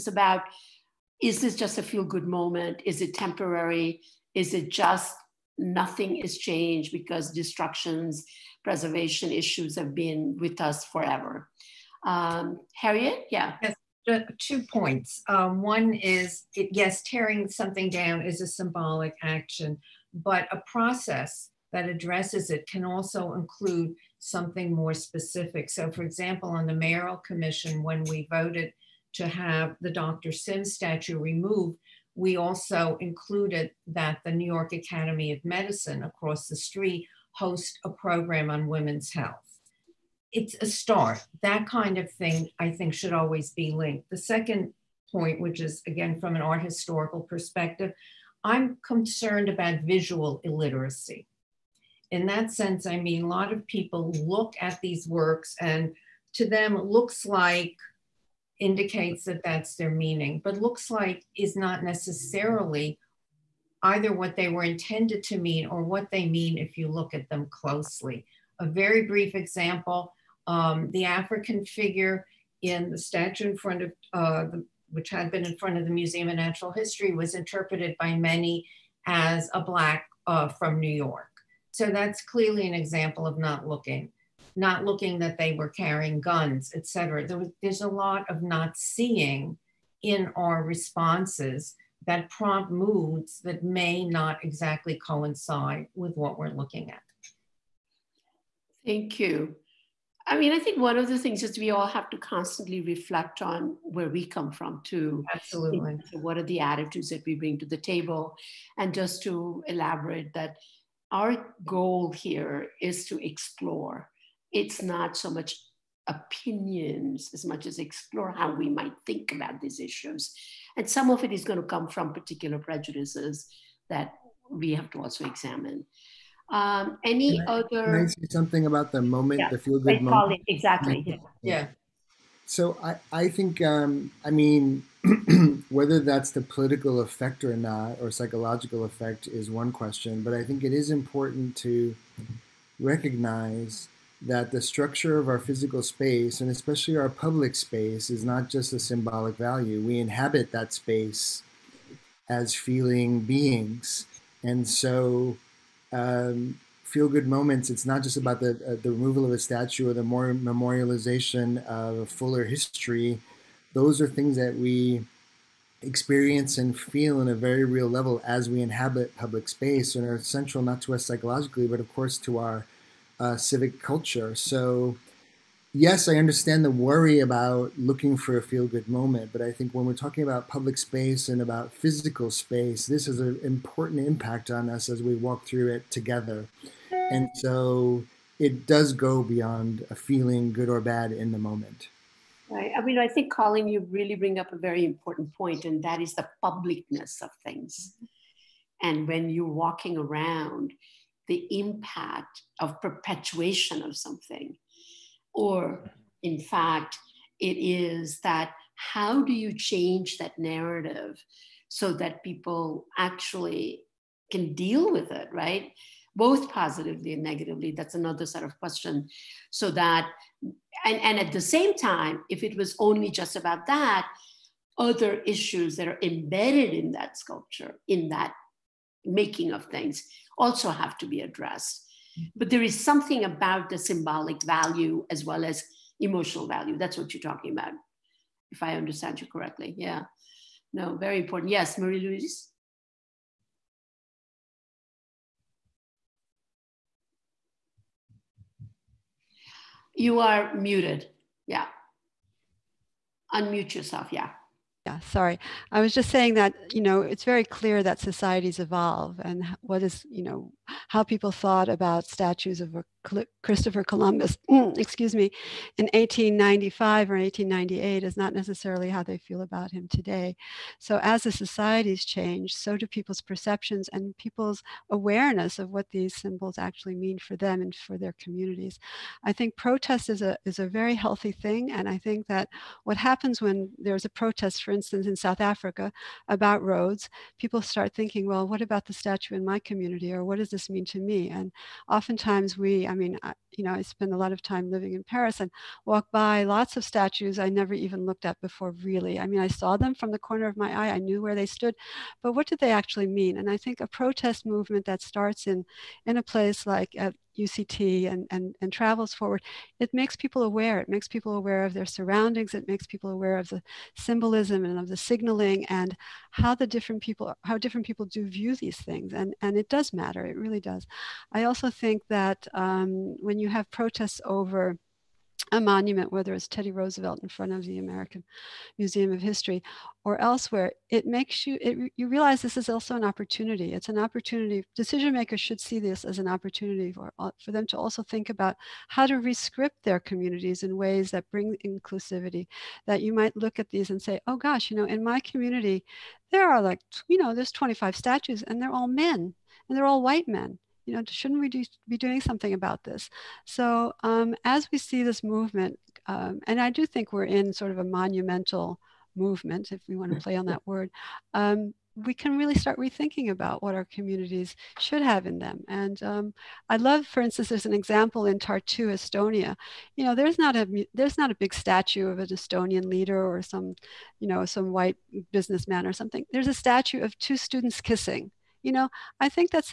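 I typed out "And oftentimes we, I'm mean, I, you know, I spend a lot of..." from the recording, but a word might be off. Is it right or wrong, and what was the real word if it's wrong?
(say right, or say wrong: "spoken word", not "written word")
right.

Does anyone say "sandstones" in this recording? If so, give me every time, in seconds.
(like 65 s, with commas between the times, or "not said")
not said.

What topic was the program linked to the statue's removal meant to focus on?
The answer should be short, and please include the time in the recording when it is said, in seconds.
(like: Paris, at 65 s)
women's health, at 38 s.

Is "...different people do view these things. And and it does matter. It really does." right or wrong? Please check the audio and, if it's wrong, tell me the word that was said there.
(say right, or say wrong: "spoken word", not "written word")
right.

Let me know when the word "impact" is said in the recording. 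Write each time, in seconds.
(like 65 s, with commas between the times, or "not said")
184 s, 201 s.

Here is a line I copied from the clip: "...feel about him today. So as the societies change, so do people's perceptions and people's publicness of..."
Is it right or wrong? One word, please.
wrong.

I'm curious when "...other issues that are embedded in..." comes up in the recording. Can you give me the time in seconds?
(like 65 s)
224 s.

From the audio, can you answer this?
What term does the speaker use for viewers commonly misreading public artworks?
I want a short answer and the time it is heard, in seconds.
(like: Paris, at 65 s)
visual illiteracy, at 49 s.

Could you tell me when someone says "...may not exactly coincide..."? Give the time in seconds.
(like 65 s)
93 s.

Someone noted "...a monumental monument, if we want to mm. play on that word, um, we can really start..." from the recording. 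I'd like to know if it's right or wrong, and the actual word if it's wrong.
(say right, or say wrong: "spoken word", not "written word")
wrong: "movement", not "monument".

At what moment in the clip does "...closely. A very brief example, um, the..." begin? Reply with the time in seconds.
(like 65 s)
67 s.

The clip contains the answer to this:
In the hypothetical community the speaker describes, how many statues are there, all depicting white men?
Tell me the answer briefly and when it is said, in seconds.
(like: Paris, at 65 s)
25, at 347 s.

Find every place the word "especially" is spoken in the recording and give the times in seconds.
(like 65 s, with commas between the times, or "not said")
146 s.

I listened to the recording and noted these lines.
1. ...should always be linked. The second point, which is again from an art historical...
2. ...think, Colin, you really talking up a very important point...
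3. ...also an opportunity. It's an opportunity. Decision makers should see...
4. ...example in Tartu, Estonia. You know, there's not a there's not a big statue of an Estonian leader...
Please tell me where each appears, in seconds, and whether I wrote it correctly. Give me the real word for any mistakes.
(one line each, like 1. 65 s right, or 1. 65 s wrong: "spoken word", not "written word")
1. 42 s right
2. 193 s wrong: "bring", not "talking"
3. 332 s right
4. 367 s right.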